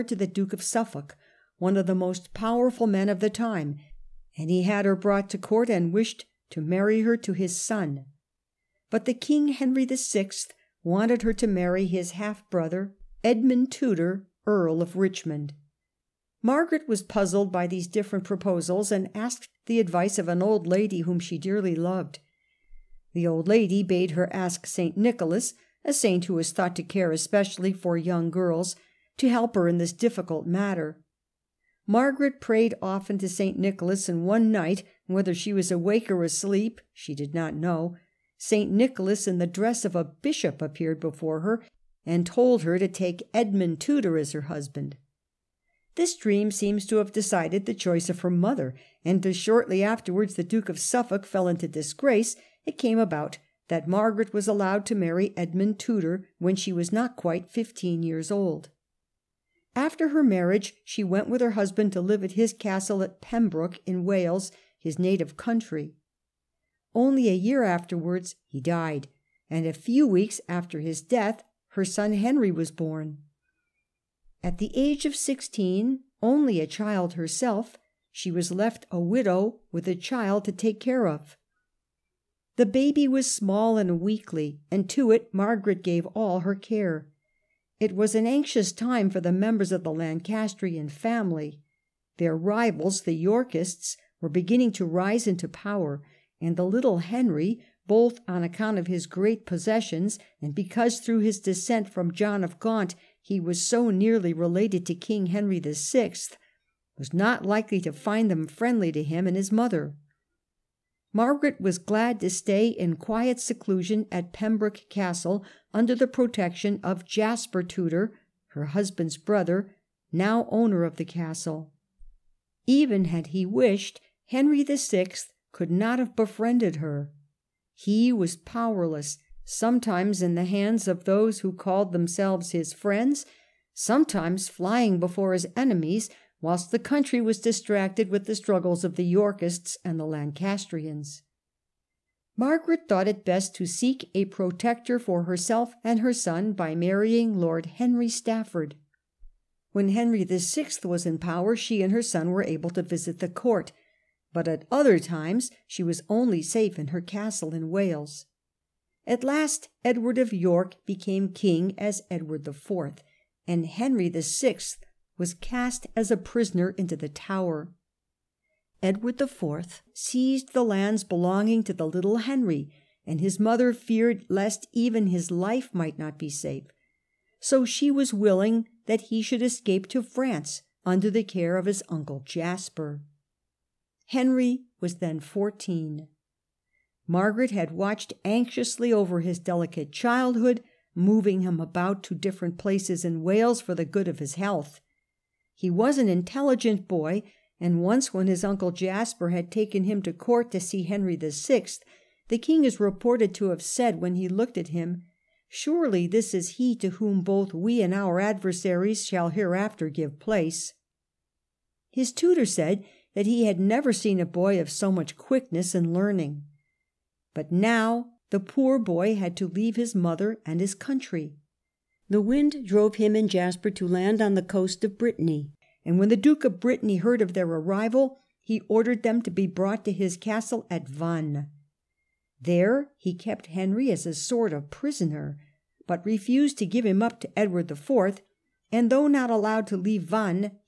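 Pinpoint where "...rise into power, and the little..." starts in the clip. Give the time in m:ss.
1:34.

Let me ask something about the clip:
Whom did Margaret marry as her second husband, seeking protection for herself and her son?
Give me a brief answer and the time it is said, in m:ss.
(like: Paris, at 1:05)
Lord Henry Stafford, at 2:27.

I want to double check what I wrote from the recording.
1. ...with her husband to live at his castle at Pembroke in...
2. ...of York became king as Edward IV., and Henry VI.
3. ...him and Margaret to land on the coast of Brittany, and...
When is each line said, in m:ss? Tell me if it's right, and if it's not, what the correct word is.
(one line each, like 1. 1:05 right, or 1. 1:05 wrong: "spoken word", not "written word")
1. 1:01 right
2. 2:40 right
3. 3:42 wrong: "Jasper", not "Margaret".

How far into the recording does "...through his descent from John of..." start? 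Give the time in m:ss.
1:40.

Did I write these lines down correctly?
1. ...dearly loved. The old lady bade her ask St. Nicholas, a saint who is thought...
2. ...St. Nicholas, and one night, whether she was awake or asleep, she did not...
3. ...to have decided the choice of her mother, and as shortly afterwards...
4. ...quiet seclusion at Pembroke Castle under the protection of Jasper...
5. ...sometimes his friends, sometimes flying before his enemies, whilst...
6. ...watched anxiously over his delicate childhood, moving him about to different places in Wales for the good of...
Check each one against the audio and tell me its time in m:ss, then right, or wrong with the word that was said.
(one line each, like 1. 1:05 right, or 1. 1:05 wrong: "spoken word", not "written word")
1. 0:21 right
2. 0:33 right
3. 0:46 right
4. 1:52 right
5. 2:11 wrong: "themselves", not "sometimes"
6. 3:07 right.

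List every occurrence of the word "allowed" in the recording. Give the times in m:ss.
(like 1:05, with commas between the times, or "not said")
0:54, 3:59.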